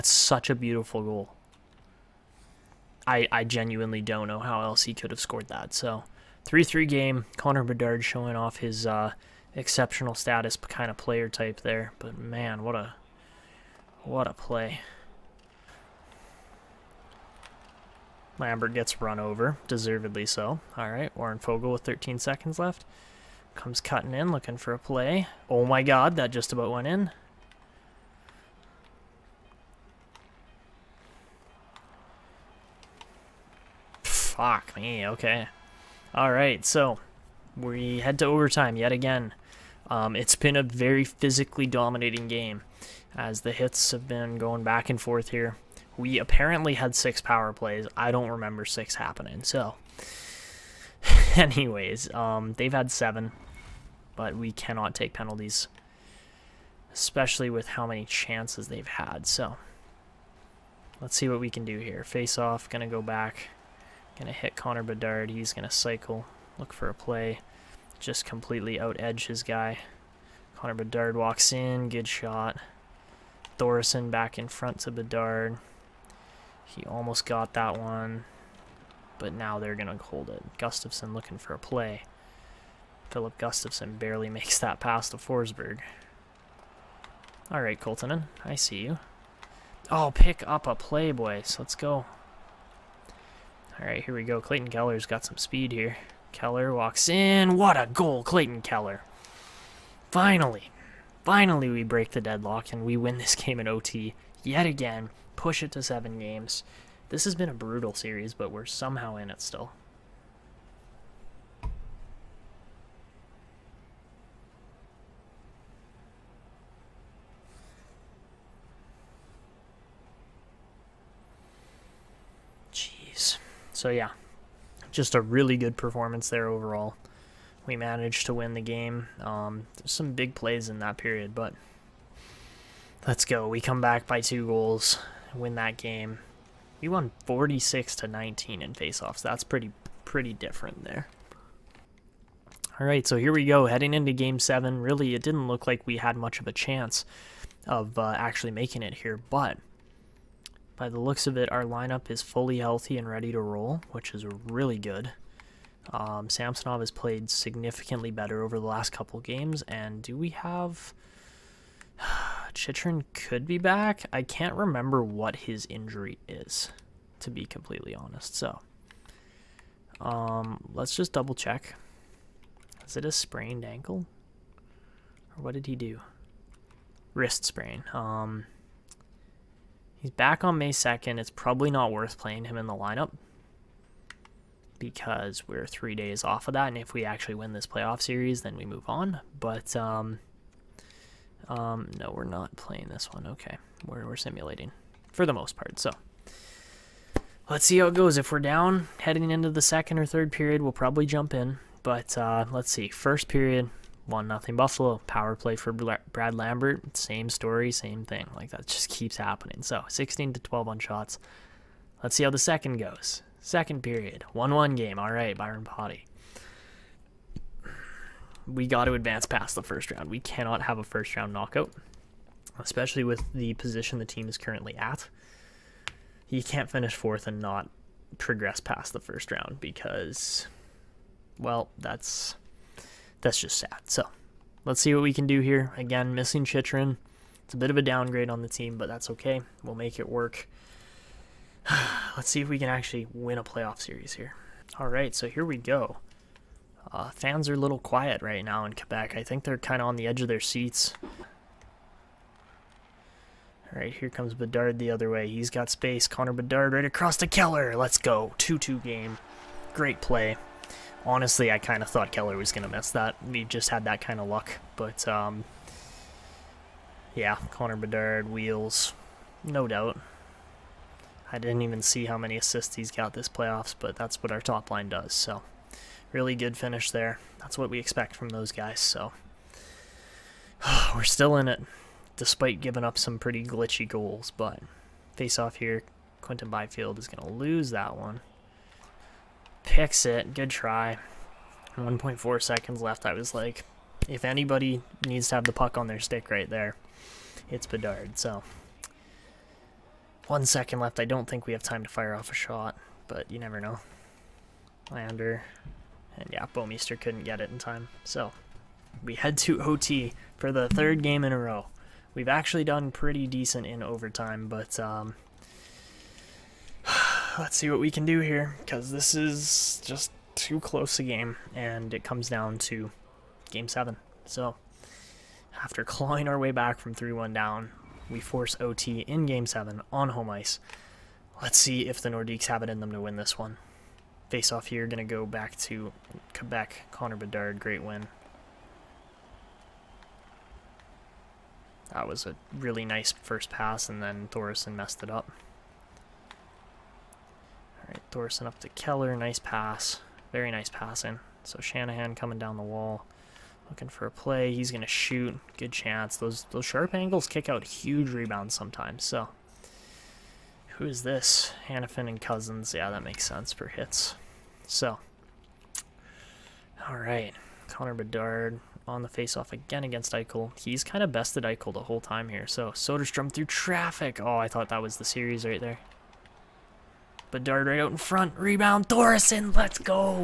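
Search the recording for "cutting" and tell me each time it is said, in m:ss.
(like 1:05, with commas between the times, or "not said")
0:23.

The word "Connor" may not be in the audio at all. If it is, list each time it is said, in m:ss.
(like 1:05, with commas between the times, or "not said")
0:07, 1:04, 1:10, 4:16, 4:27, 5:36, 6:07.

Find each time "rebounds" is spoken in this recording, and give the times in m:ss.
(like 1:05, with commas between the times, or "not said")
5:58, 6:18.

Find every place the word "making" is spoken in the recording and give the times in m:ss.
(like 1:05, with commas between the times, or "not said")
2:28.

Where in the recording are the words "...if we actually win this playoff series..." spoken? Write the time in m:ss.
3:06.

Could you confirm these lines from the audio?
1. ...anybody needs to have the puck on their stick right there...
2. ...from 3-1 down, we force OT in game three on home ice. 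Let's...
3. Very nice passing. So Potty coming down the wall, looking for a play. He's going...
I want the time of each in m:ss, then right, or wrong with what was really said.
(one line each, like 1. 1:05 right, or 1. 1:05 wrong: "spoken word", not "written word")
1. 4:54 right
2. 5:26 wrong: "seven", not "three"
3. 5:50 wrong: "Shanahan", not "Potty".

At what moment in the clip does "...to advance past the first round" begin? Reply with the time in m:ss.
3:38.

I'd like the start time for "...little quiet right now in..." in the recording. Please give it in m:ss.
4:07.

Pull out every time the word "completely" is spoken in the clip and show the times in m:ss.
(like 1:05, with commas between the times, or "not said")
1:08, 2:47.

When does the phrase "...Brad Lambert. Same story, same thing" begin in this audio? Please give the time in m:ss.
3:25.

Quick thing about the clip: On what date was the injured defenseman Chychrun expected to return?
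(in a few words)
May 2nd.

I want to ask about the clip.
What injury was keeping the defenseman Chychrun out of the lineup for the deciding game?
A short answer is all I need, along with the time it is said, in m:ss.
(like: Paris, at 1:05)
Wrist sprain, at 2:57.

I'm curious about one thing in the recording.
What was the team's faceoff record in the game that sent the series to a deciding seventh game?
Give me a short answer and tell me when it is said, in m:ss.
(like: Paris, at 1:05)
46 to 19, at 2:17.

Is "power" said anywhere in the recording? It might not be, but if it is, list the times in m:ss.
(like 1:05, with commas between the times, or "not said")
0:47, 3:25.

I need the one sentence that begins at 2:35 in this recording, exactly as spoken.
Um, Samsonov has played significantly better over the last couple games, and do we have...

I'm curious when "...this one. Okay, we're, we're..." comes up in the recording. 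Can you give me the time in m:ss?
3:12.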